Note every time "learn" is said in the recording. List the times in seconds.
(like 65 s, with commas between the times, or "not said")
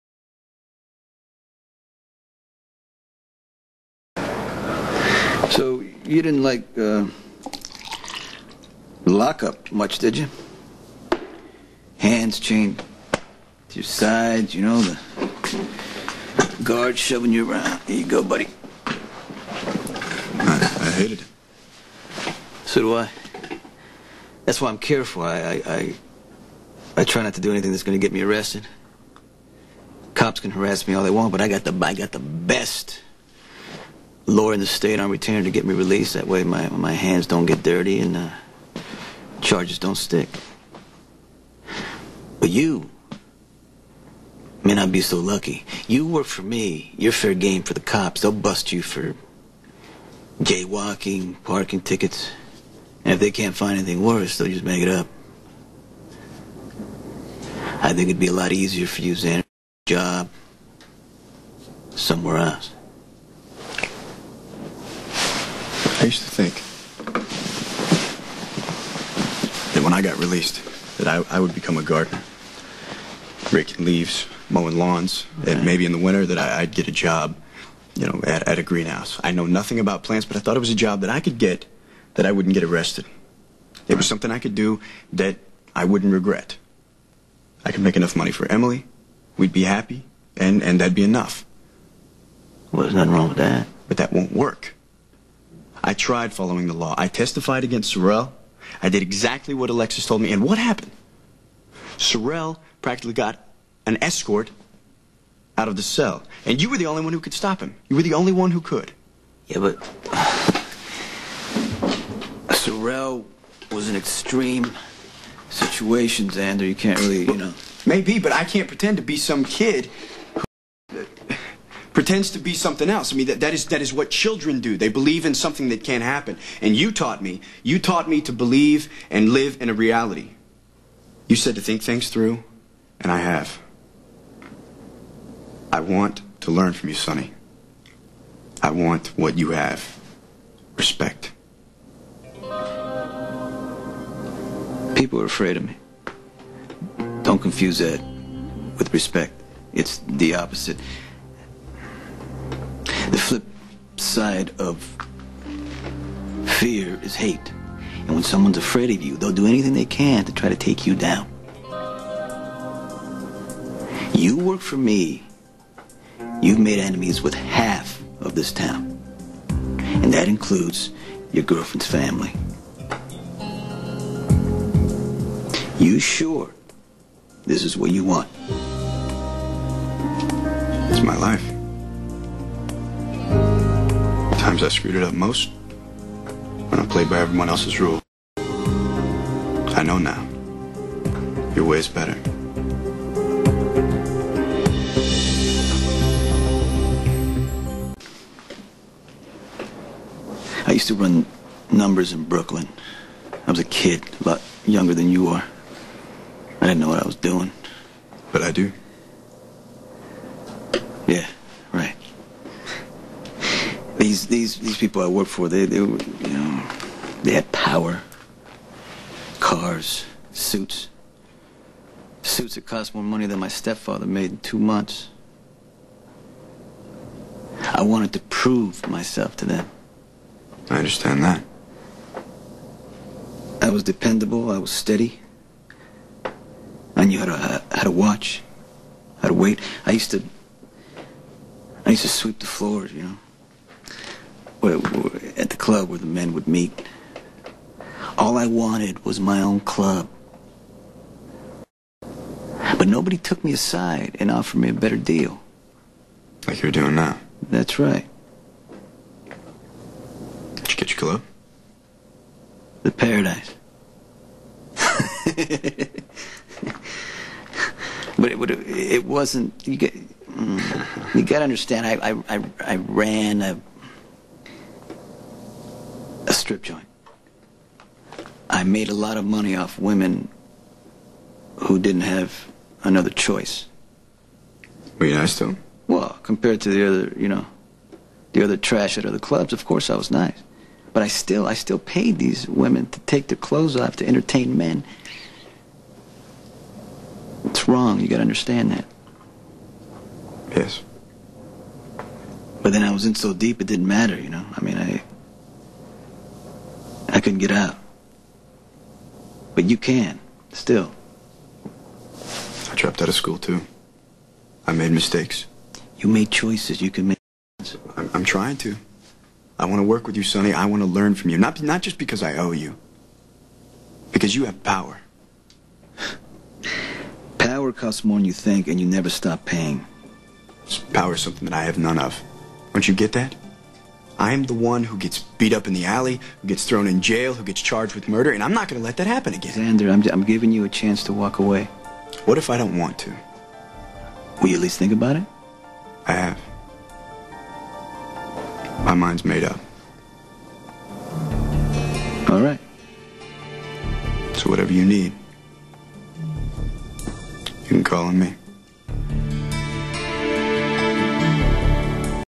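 136 s, 320 s.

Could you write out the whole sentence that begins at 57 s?
I think it'd be a lot easier for you, Zander, job somewhere else.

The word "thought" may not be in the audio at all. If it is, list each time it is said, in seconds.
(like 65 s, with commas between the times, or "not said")
80 s.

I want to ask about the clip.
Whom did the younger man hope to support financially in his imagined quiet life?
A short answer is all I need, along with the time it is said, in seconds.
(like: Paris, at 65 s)
Emily, at 88 s.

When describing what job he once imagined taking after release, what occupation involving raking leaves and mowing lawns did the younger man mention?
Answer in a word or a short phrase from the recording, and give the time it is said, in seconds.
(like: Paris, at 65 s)
gardener, at 71 s.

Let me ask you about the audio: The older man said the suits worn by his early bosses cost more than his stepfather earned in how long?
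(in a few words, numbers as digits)
two months.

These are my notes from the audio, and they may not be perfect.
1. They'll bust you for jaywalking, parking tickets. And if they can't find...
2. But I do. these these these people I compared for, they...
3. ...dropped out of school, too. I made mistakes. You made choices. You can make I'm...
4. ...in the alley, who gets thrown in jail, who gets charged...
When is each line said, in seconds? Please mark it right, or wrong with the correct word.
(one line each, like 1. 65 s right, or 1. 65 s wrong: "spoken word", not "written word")
1. 48 s right
2. 208 s wrong: "worked", not "compared"
3. 312 s right
4. 335 s right.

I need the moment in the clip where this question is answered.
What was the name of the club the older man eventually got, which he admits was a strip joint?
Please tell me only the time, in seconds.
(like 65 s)
262 s.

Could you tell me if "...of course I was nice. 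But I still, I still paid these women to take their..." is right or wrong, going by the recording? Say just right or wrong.
right.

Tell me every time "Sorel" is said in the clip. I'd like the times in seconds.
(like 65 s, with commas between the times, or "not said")
97 s, 101 s, 112 s.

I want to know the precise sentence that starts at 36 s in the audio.
That way my, my hands don't get dirty and uh, charges don't stick.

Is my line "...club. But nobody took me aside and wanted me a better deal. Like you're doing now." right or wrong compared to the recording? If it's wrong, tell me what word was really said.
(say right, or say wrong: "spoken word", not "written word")
wrong: "offered", not "wanted".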